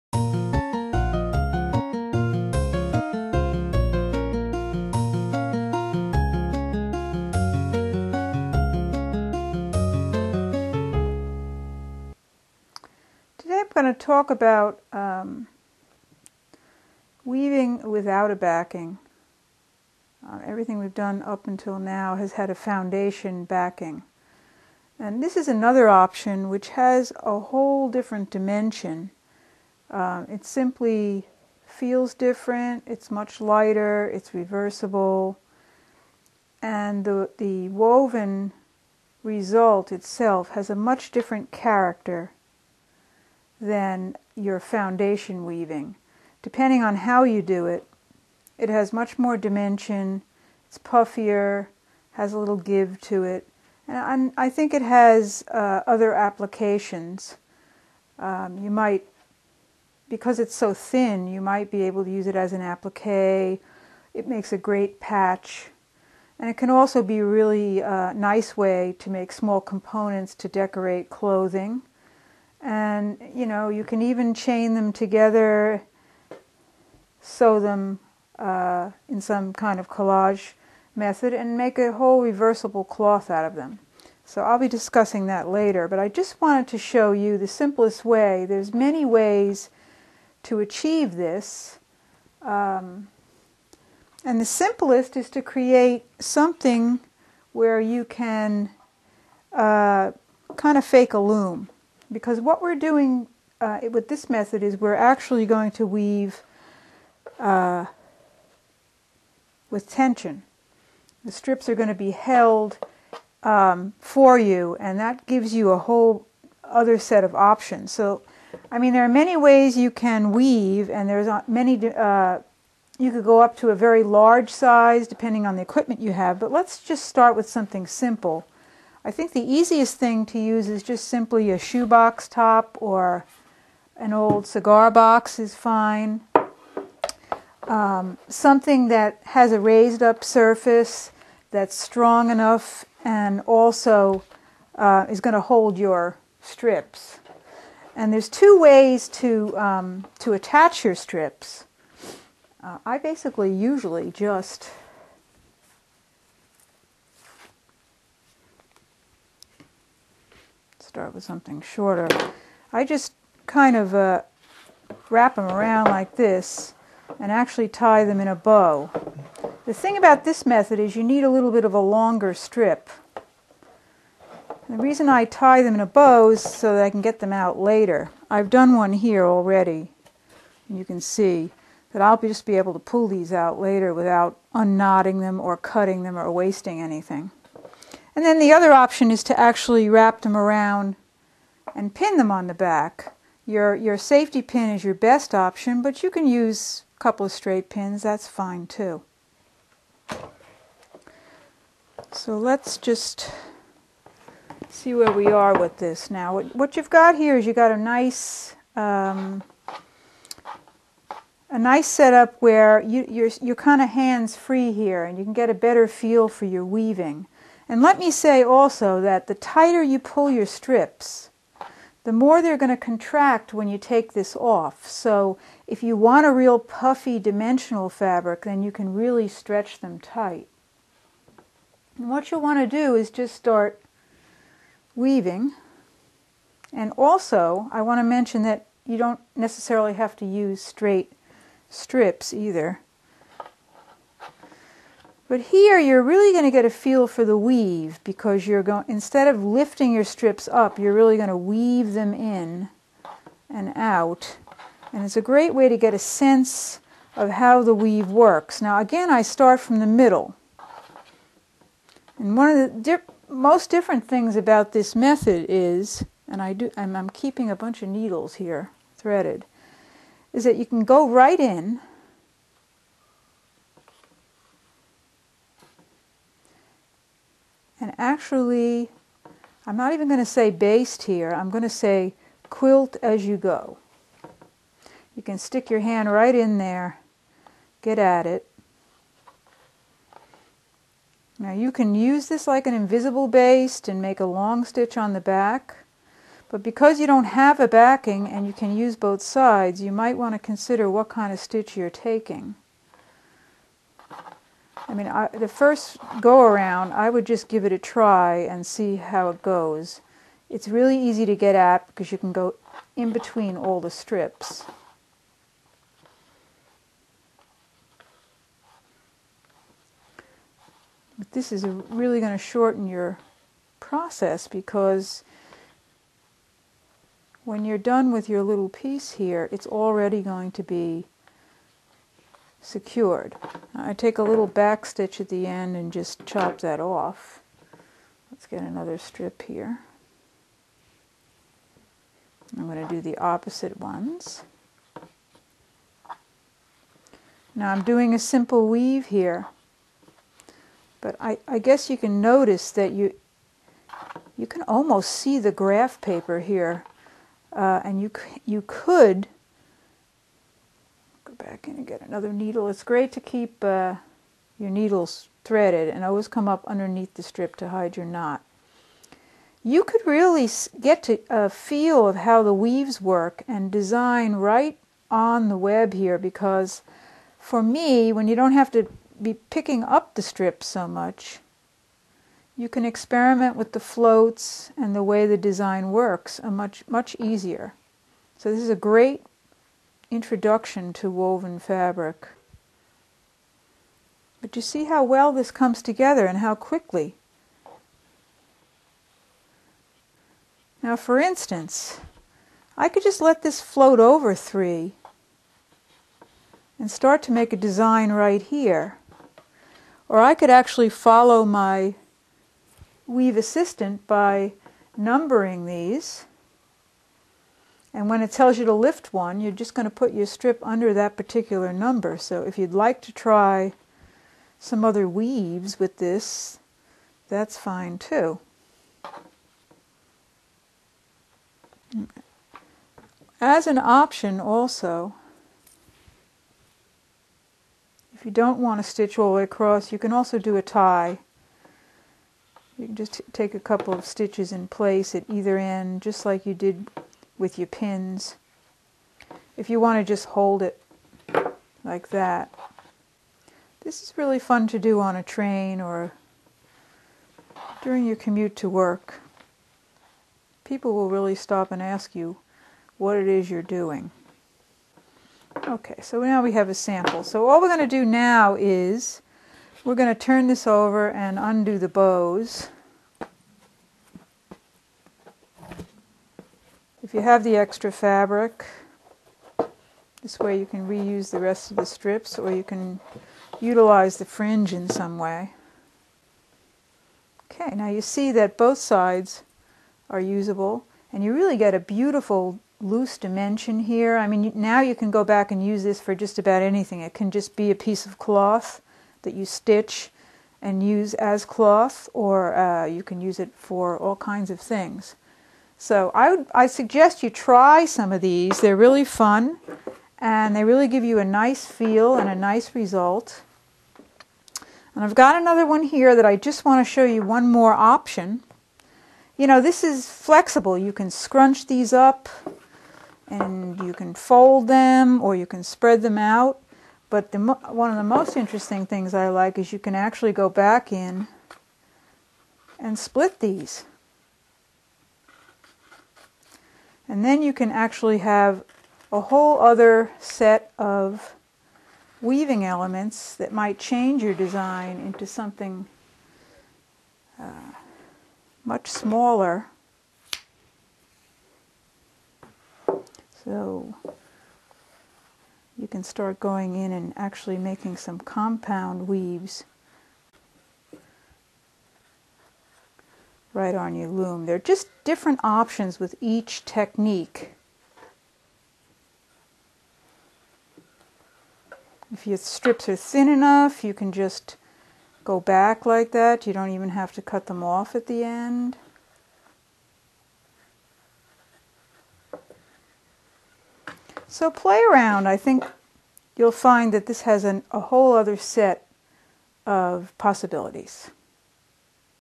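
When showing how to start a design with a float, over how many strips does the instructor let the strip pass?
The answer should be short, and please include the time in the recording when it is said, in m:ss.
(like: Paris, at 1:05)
3, at 6:44.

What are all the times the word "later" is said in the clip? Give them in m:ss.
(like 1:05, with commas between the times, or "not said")
1:25, 2:57, 3:03.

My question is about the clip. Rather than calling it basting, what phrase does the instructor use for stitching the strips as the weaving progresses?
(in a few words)
quilt as you go.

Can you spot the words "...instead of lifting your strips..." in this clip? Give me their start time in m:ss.
4:08.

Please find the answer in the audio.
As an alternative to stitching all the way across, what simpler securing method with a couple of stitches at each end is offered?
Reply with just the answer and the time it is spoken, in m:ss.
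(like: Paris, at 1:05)
a tie, at 7:20.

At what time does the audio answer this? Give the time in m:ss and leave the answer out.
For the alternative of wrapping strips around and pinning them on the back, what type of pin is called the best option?
3:13.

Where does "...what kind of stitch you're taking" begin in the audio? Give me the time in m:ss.
5:00.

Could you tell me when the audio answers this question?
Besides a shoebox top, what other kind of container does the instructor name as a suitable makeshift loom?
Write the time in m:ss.
2:14.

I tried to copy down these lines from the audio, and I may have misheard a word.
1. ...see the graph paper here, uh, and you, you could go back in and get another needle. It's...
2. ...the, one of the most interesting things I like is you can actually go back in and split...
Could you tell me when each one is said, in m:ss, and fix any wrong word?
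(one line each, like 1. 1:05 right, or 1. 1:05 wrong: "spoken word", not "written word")
1. 5:55 right
2. 8:47 right.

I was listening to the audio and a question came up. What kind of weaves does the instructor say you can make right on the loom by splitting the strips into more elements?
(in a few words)
compound weaves.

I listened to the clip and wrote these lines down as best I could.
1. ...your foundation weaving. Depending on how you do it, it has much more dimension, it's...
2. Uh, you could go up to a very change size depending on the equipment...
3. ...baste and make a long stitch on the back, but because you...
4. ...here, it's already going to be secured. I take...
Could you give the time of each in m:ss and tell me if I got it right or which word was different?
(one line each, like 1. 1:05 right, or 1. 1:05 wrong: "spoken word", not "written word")
1. 0:44 right
2. 2:01 wrong: "large", not "change"
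3. 4:53 right
4. 5:29 right.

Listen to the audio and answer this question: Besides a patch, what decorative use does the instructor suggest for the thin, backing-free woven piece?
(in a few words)
applique.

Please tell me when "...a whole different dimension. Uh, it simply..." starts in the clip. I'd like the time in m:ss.
0:27.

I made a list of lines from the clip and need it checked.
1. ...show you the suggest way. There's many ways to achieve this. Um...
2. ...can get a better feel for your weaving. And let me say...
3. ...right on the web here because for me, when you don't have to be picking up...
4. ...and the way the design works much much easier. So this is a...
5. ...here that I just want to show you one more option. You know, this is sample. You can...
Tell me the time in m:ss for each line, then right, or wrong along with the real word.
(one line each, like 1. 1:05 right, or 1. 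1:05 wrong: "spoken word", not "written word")
1. 1:26 wrong: "simplest", not "suggest"
2. 3:35 right
3. 6:14 right
4. 6:24 right
5. 8:35 wrong: "flexible", not "sample".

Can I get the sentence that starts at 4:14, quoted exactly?
And it's a great way to get a sense of how the weave works.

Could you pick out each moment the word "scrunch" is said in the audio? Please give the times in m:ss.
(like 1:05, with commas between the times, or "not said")
8:41.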